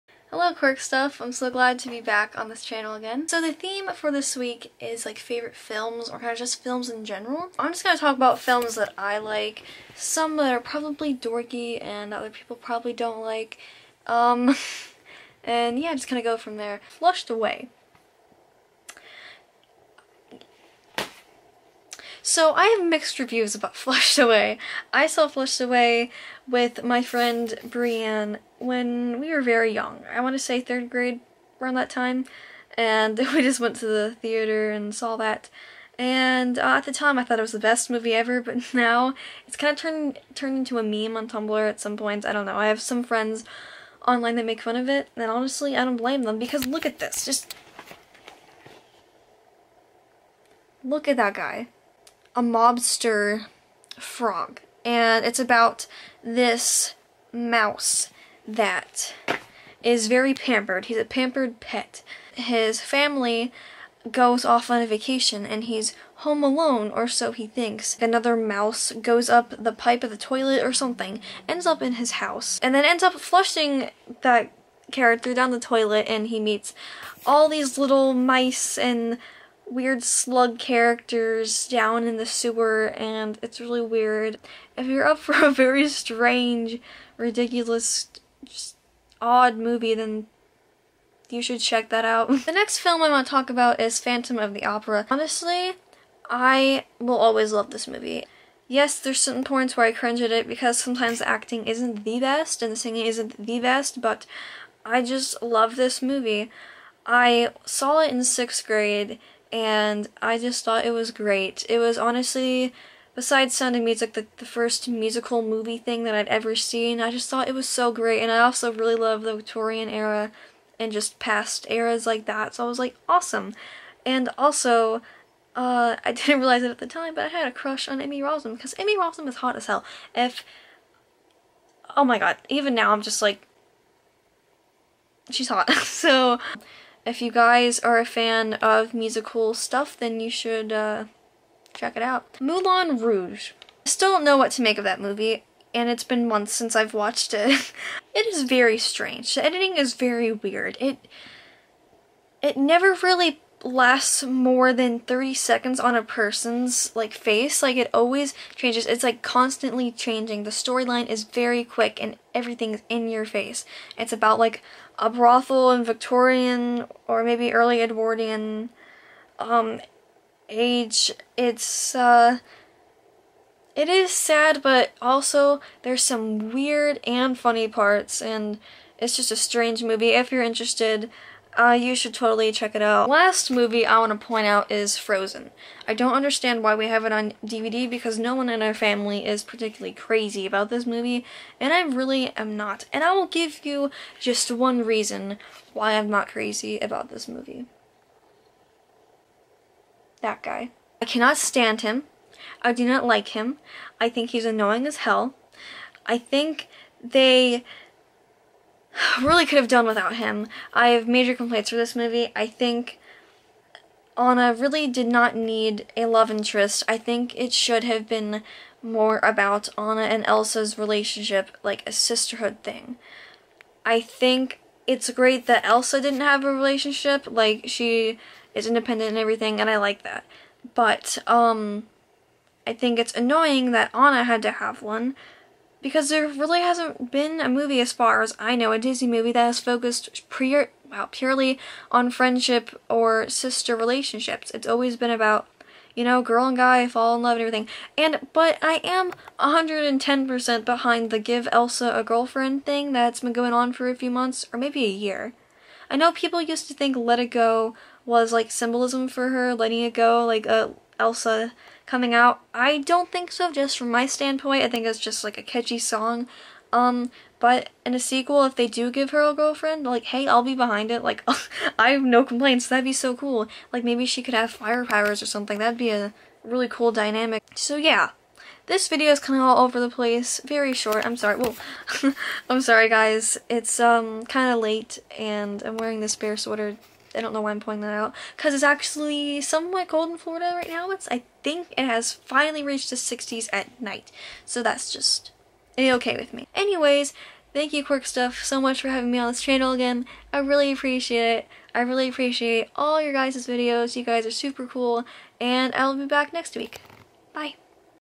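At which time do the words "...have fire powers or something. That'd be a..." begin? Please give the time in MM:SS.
04:34.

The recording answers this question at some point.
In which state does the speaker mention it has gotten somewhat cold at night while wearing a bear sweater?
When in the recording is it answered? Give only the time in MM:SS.
04:50.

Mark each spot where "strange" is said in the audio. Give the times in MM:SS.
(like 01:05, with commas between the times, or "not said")
01:25, 02:28, 02:59.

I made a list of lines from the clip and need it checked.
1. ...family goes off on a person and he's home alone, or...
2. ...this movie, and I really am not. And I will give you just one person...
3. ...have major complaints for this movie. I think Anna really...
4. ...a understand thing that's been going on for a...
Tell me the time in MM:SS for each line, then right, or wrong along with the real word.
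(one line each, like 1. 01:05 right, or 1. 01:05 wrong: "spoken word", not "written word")
1. 01:02 wrong: "vacation", not "person"
2. 03:10 wrong: "reason", not "person"
3. 03:30 right
4. 04:11 wrong: "girlfriend", not "understand".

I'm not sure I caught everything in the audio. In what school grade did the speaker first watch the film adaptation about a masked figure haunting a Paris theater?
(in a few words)
Sixth grade.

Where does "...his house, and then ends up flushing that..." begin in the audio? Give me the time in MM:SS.
01:11.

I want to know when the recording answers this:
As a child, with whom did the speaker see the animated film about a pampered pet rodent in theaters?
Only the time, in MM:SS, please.
00:27.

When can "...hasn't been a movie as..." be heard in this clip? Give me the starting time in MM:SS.
03:56.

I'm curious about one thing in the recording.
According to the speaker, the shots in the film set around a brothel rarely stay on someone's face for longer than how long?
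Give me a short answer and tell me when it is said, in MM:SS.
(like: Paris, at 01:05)
30 seconds, at 02:34.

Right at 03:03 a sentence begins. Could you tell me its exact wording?
Last movie I want to point out is Frozen.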